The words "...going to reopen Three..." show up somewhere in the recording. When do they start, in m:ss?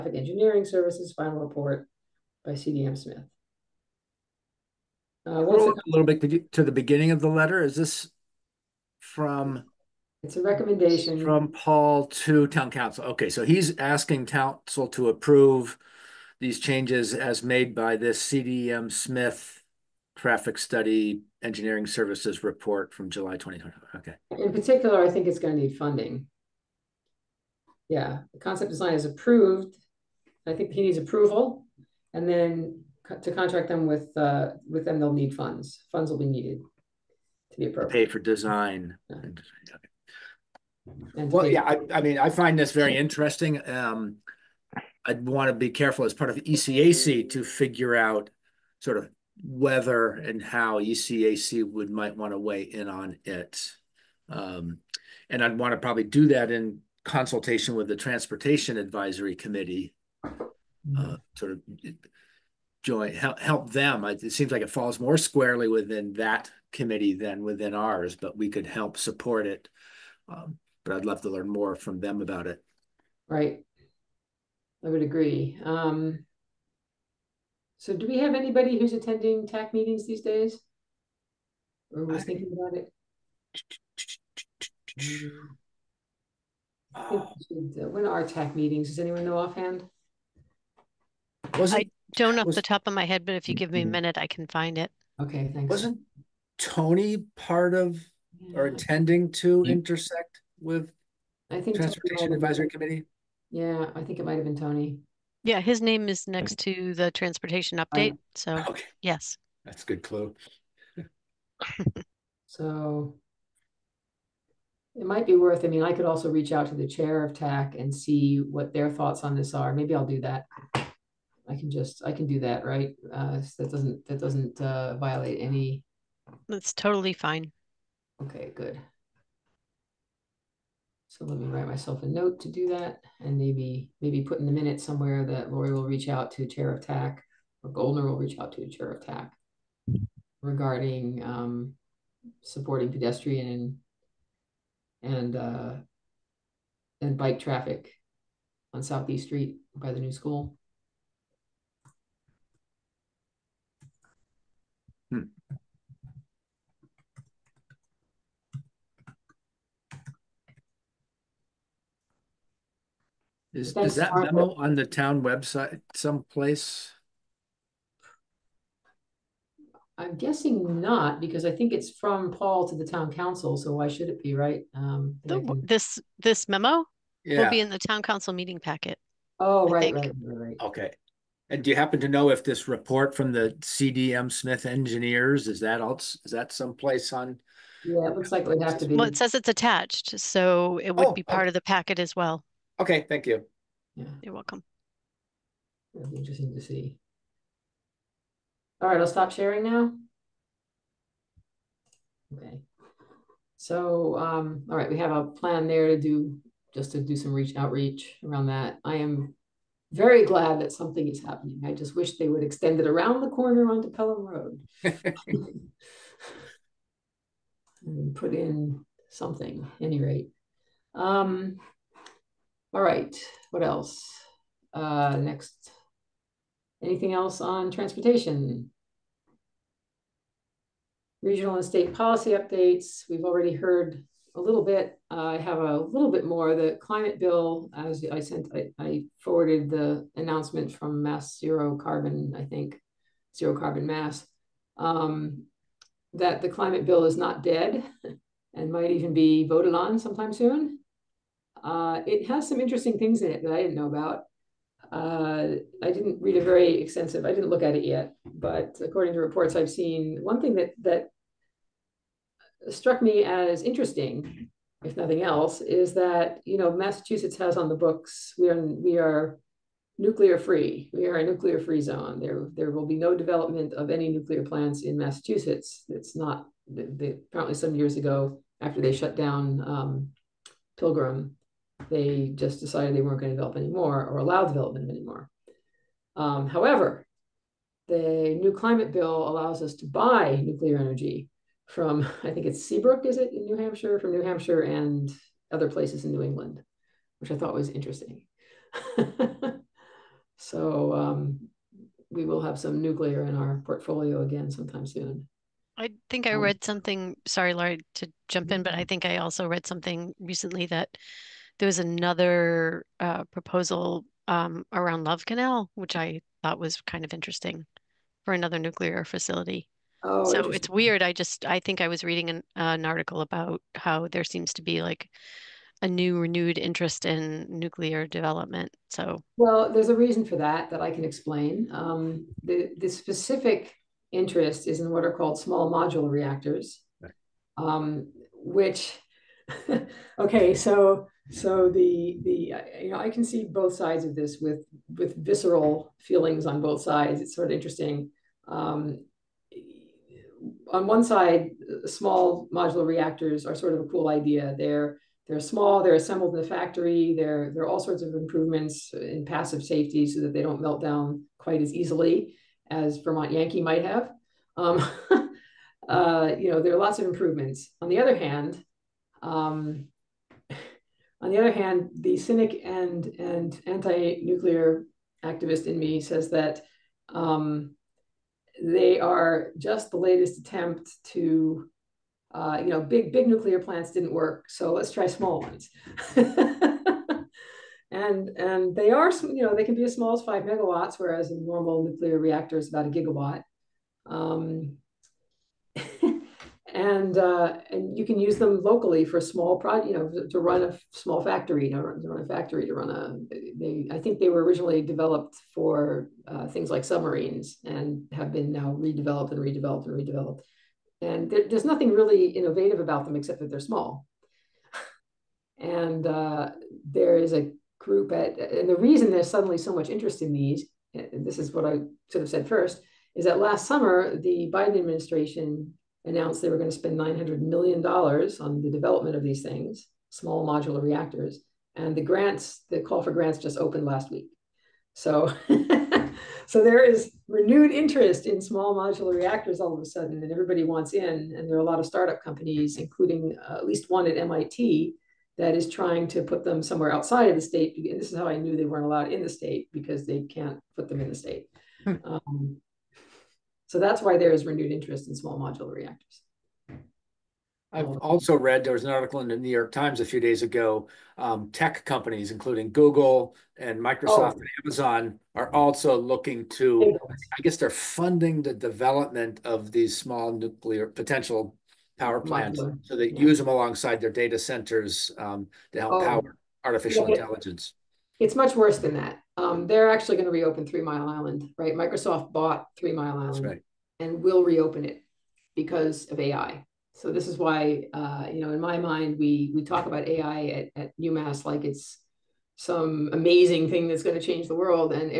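8:00.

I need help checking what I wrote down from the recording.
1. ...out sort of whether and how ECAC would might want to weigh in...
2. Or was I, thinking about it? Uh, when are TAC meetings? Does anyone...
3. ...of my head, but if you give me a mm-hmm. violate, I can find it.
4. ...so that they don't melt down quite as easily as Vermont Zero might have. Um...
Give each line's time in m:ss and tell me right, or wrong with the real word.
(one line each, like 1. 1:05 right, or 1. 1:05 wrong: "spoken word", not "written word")
1. 0:47 right
2. 1:21 right
3. 1:32 wrong: "minute", not "violate"
4. 6:00 wrong: "Yankee", not "Zero".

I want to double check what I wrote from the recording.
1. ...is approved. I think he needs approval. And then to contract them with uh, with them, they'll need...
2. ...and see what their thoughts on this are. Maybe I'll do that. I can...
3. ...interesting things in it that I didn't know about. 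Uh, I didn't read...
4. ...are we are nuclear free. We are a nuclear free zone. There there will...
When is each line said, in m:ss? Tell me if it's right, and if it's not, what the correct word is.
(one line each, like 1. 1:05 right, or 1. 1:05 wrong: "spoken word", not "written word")
1. 0:28 right
2. 1:57 right
3. 4:12 right
4. 4:28 right.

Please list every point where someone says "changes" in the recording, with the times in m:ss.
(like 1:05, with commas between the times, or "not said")
0:16, 8:14.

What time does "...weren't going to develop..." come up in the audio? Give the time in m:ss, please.
4:43.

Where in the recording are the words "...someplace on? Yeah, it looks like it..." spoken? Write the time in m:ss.
3:06.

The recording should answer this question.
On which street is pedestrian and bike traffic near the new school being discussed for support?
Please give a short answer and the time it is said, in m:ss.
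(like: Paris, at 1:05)
Southeast Street, at 2:28.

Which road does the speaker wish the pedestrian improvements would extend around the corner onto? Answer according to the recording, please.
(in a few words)
Pelham Road.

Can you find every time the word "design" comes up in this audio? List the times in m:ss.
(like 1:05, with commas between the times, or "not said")
0:28, 0:38.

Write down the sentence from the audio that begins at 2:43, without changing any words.
Is, is that memo on the town website someplace?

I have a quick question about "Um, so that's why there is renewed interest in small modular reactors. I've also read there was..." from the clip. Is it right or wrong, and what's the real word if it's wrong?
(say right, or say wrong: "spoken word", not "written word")
right.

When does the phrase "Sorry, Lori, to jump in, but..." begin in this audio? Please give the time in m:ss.
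5:07.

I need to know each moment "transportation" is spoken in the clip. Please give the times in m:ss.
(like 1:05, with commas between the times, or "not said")
0:57, 1:41, 1:47, 3:47.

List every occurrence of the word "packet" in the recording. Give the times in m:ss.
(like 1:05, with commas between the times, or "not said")
2:58, 3:11.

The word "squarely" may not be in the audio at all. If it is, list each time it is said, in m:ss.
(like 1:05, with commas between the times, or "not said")
1:05.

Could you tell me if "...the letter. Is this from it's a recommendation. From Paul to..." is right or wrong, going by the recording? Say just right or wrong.
right.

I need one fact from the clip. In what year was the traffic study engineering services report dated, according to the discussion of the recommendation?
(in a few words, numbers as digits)
2020.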